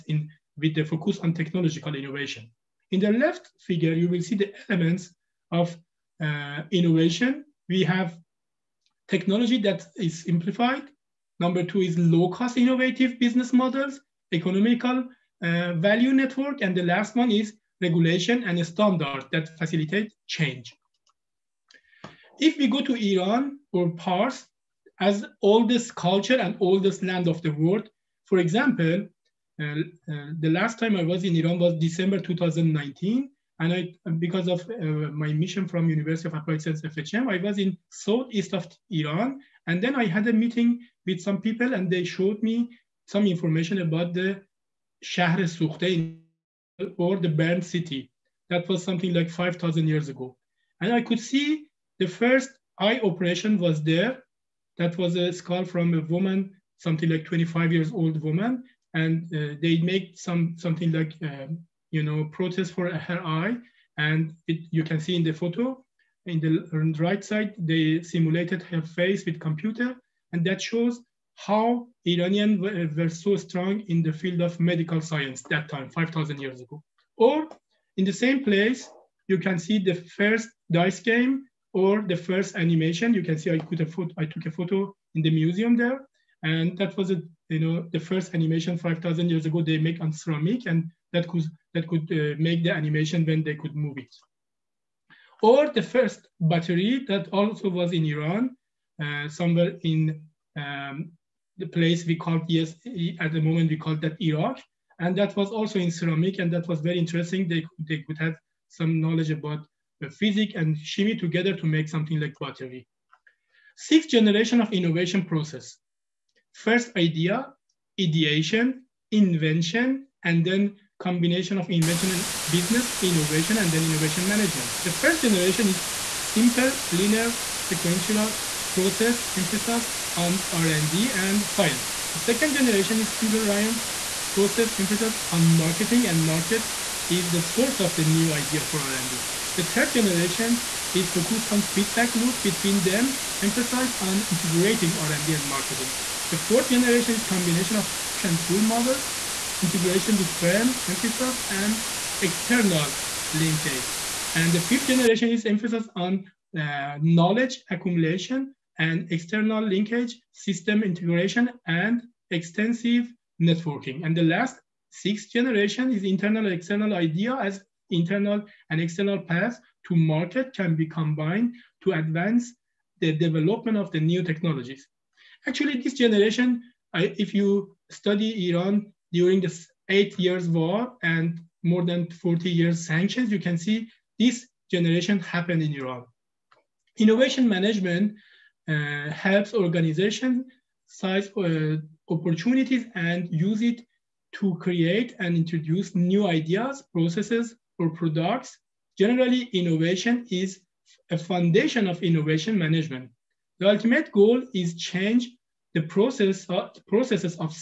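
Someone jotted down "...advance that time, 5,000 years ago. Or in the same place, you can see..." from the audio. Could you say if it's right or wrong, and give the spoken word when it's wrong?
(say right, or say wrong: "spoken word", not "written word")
wrong: "science", not "advance".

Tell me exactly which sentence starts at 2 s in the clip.
In the left figure, you will see the elements of uh, innovation.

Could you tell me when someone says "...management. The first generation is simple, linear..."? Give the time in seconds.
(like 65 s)
124 s.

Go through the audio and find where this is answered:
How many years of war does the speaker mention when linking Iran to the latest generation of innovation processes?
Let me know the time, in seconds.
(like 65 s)
179 s.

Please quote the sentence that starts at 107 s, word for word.
They they could have some knowledge about the physics and chemistry together to make something like pottery.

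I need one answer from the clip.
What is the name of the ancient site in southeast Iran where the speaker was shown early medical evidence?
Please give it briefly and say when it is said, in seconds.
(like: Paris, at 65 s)
Shahr Sukhte, at 45 s.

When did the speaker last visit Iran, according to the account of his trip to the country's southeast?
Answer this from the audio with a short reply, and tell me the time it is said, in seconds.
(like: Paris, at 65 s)
December 2019, at 31 s.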